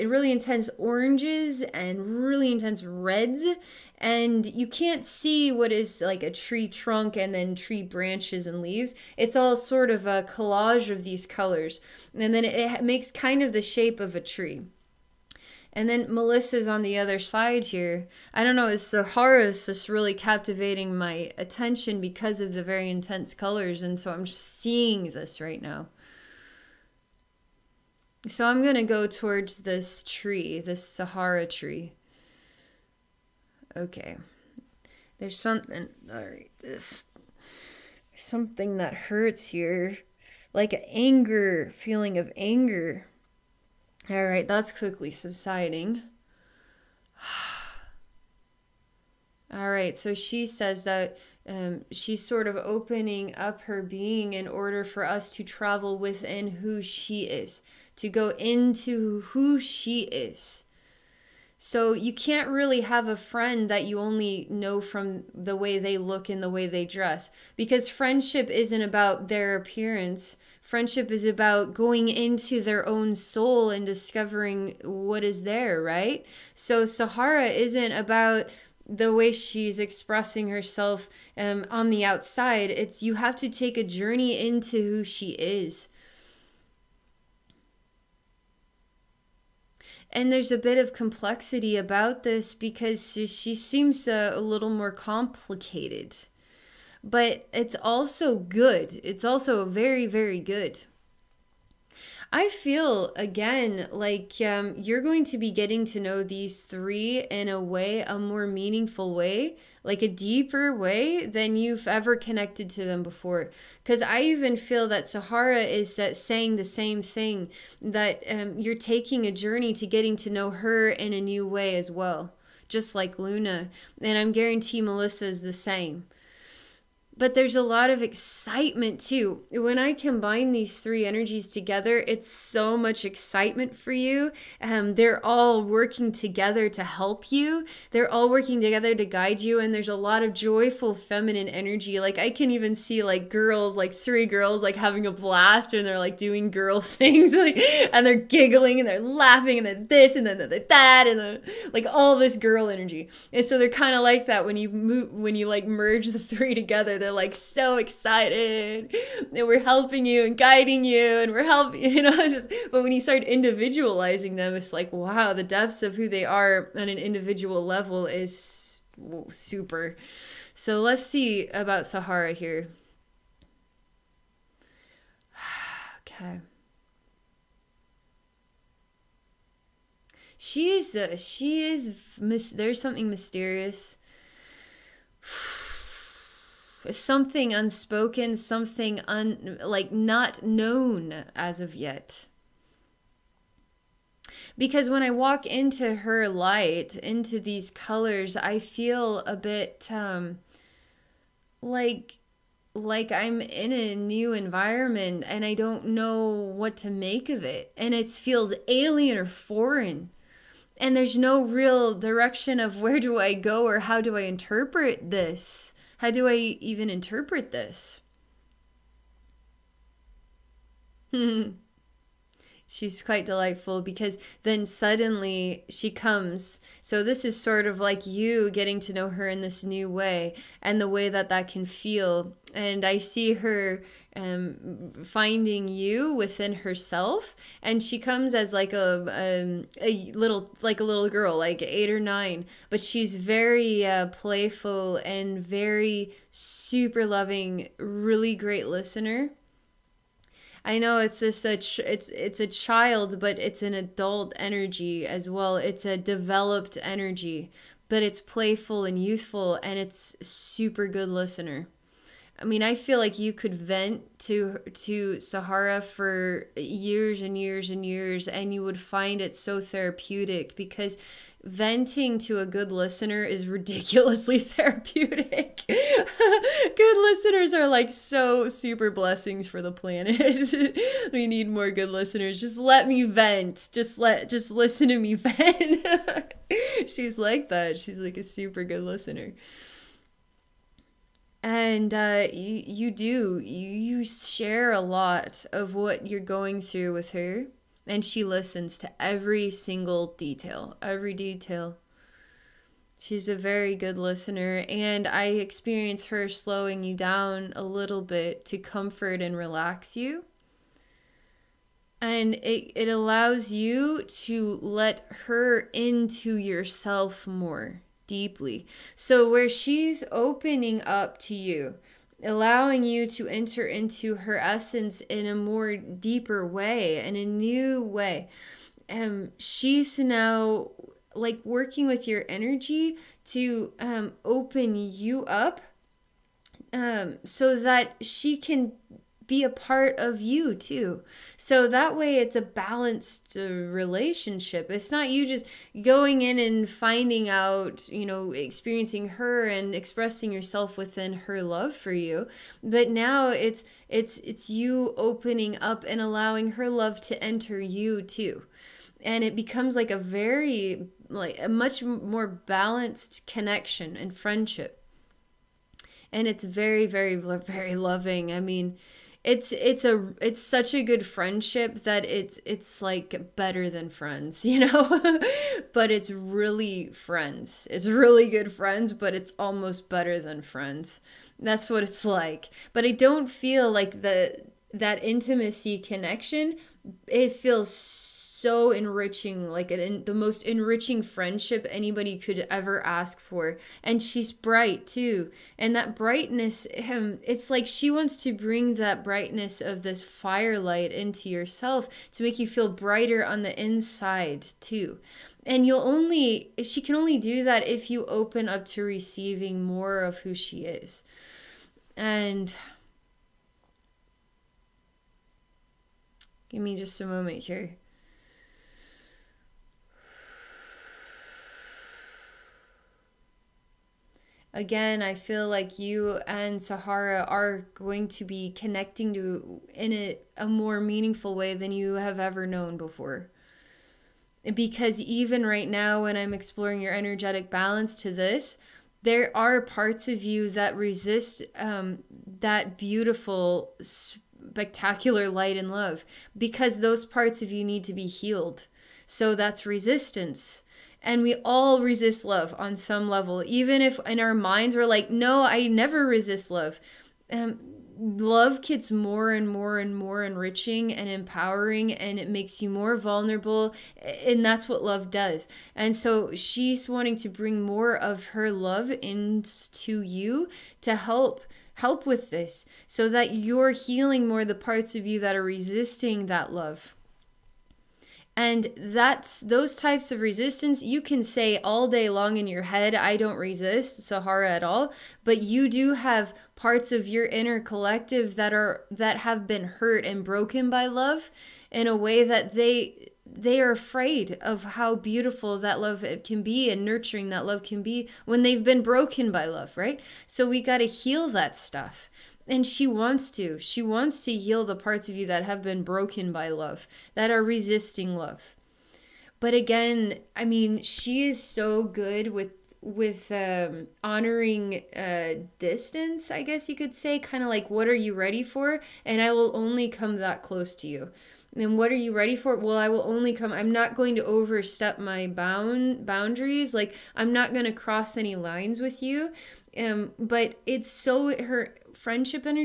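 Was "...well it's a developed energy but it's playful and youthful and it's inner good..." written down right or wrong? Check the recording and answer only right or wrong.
wrong.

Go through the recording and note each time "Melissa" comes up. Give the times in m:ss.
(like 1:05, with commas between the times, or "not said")
0:16, 2:04.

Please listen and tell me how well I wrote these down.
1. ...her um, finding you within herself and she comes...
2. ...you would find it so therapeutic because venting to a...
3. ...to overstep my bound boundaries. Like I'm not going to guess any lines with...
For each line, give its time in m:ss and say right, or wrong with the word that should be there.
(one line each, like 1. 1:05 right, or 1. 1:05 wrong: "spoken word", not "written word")
1. 3:53 right
2. 4:28 right
3. 8:44 wrong: "cross", not "guess".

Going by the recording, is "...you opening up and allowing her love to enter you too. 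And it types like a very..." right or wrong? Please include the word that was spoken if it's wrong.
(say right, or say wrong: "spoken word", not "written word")
wrong: "becomes", not "types".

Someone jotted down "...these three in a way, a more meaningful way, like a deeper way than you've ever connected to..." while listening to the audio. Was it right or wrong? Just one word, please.
right.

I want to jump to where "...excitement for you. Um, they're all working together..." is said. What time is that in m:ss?
2:13.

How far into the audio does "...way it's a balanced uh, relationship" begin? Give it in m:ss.
5:41.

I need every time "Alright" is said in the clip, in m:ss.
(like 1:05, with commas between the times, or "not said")
0:36, 0:44, 0:49.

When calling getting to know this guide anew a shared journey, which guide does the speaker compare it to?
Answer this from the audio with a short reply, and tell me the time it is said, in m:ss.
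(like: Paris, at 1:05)
Luna, at 2:03.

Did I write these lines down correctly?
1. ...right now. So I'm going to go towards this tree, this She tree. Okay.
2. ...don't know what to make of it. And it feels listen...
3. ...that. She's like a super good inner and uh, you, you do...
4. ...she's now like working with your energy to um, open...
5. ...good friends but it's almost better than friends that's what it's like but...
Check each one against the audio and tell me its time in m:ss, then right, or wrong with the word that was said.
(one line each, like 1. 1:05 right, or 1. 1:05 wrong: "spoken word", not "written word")
1. 0:25 wrong: "Sahara", not "She"
2. 3:25 wrong: "alien", not "listen"
3. 4:47 wrong: "listener", not "inner"
4. 5:29 right
5. 6:18 right.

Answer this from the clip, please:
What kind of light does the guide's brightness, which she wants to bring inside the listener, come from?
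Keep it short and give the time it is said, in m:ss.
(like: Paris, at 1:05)
firelight, at 6:40.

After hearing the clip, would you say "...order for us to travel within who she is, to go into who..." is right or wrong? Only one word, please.
right.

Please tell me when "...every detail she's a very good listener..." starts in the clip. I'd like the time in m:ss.
5:00.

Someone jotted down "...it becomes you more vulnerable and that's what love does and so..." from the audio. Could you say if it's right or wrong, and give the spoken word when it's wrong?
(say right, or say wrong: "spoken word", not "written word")
wrong: "makes", not "becomes".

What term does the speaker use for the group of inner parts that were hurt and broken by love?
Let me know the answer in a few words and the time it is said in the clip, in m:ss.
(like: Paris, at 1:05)
inner collective, at 8:07.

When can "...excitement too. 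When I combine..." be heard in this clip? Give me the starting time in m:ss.
2:08.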